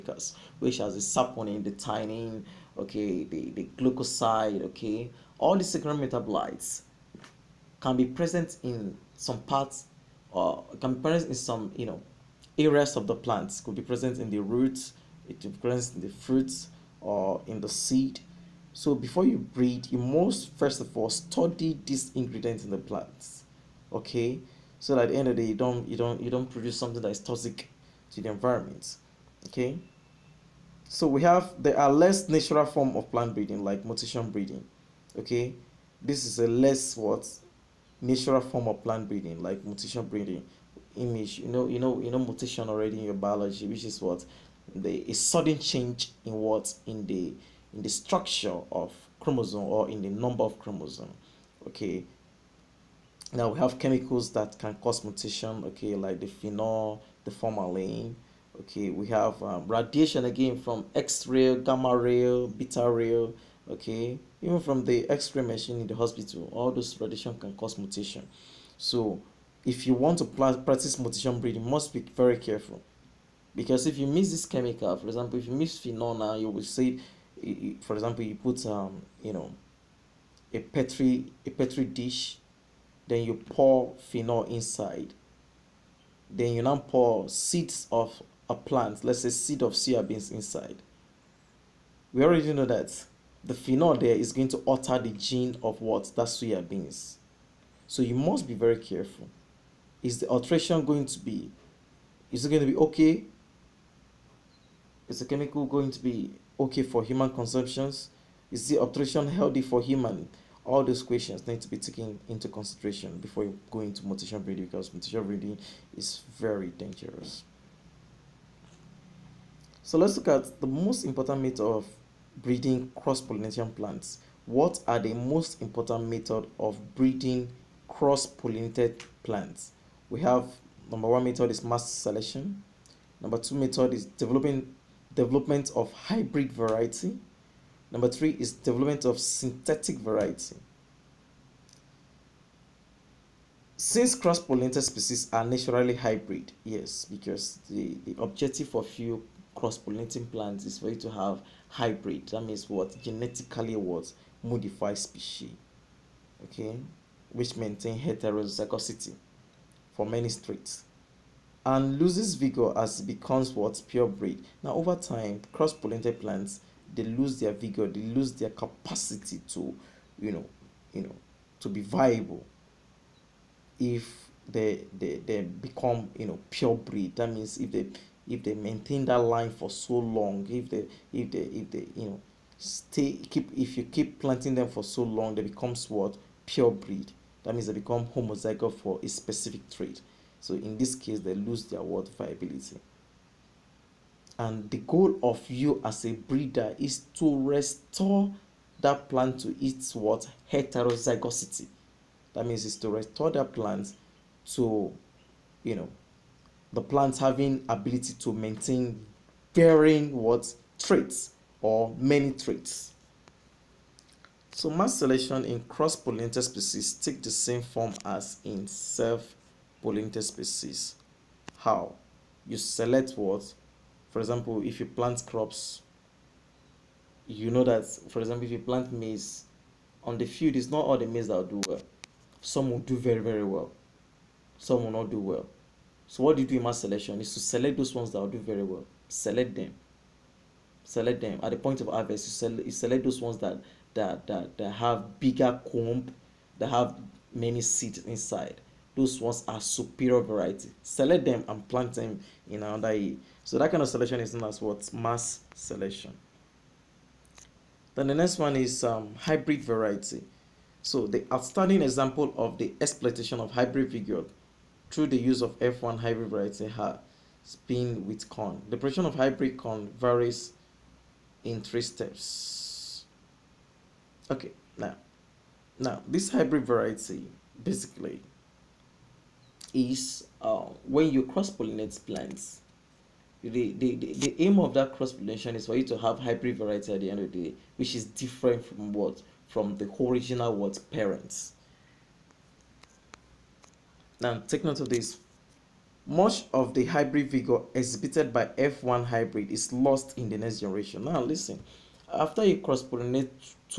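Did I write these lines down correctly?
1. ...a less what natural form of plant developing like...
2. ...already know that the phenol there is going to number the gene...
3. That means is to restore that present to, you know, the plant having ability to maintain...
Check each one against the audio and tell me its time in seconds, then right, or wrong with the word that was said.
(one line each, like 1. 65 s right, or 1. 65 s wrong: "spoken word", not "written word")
1. 36 s wrong: "breeding", not "developing"
2. 92 s wrong: "alter", not "number"
3. 202 s wrong: "plant", not "present".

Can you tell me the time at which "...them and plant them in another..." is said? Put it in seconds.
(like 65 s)
251 s.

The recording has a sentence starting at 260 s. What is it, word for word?
So the outstanding example of the exploitation of hybrid vigor through the use of F1 hybrid variety has been with corn.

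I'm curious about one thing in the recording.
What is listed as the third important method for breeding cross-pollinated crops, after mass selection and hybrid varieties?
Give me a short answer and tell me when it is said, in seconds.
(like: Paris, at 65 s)
Development of synthetic variety, at 138 s.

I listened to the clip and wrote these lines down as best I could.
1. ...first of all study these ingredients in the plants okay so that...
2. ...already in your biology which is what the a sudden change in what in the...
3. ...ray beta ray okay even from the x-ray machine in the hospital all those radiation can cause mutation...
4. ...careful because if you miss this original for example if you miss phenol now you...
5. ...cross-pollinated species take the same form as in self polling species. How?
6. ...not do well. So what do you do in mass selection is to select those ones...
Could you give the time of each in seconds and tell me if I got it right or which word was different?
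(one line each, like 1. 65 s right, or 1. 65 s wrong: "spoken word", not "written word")
1. 20 s right
2. 42 s right
3. 61 s right
4. 72 s wrong: "chemical", not "original"
5. 215 s right
6. 234 s right.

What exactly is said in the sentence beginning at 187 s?
That means they become homozygous for a specific trait.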